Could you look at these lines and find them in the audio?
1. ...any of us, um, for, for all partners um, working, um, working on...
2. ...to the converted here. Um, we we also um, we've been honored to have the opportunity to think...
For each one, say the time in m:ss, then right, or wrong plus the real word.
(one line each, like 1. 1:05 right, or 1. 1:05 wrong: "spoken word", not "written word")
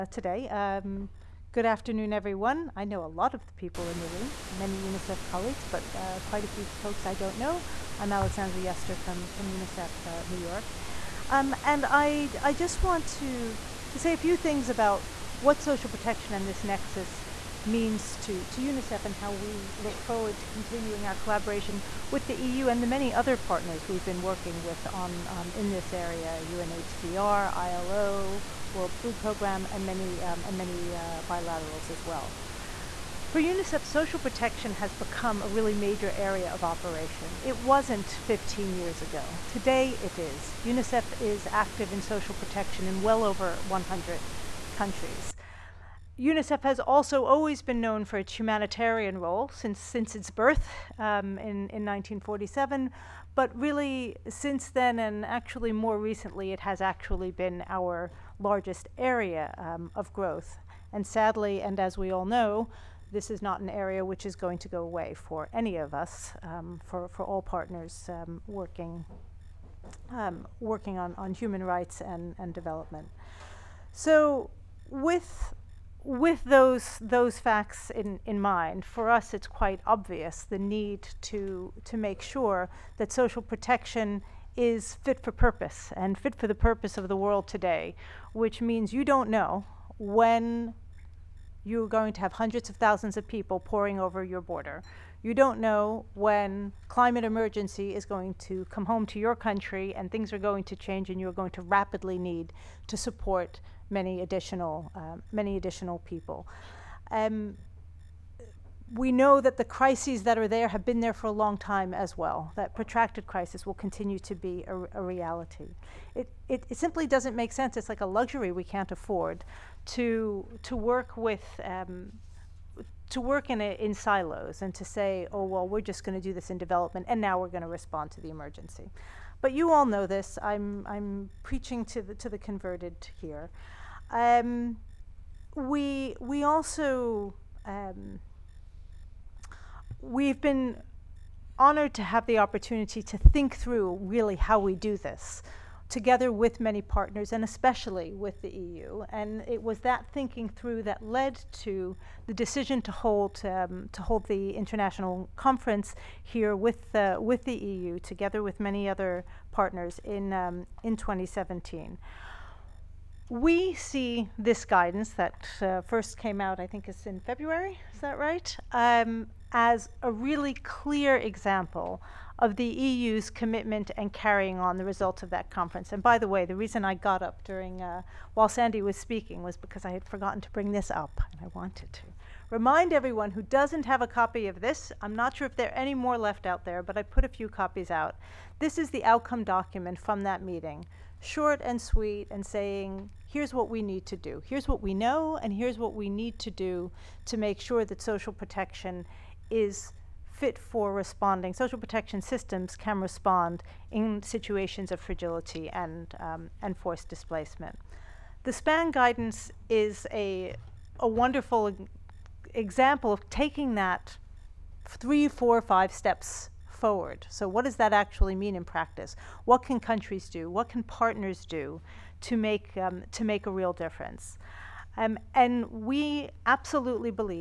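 1. 1:05 right
2. 2:12 right.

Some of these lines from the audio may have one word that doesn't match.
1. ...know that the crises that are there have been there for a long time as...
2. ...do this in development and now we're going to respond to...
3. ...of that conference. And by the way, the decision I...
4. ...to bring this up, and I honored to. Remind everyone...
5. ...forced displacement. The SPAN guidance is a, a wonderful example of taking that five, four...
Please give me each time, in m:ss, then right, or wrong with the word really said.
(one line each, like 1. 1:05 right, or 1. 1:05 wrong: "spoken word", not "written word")
1. 1:49 right
2. 2:06 right
3. 2:55 wrong: "reason", not "decision"
4. 3:00 wrong: "wanted", not "honored"
5. 3:26 wrong: "three", not "five".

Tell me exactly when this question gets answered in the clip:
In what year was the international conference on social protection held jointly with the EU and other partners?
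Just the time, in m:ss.
2:40.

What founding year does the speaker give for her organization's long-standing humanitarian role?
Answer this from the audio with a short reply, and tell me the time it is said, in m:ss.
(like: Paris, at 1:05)
1947, at 0:51.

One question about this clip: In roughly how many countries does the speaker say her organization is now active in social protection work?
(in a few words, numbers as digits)
over 100.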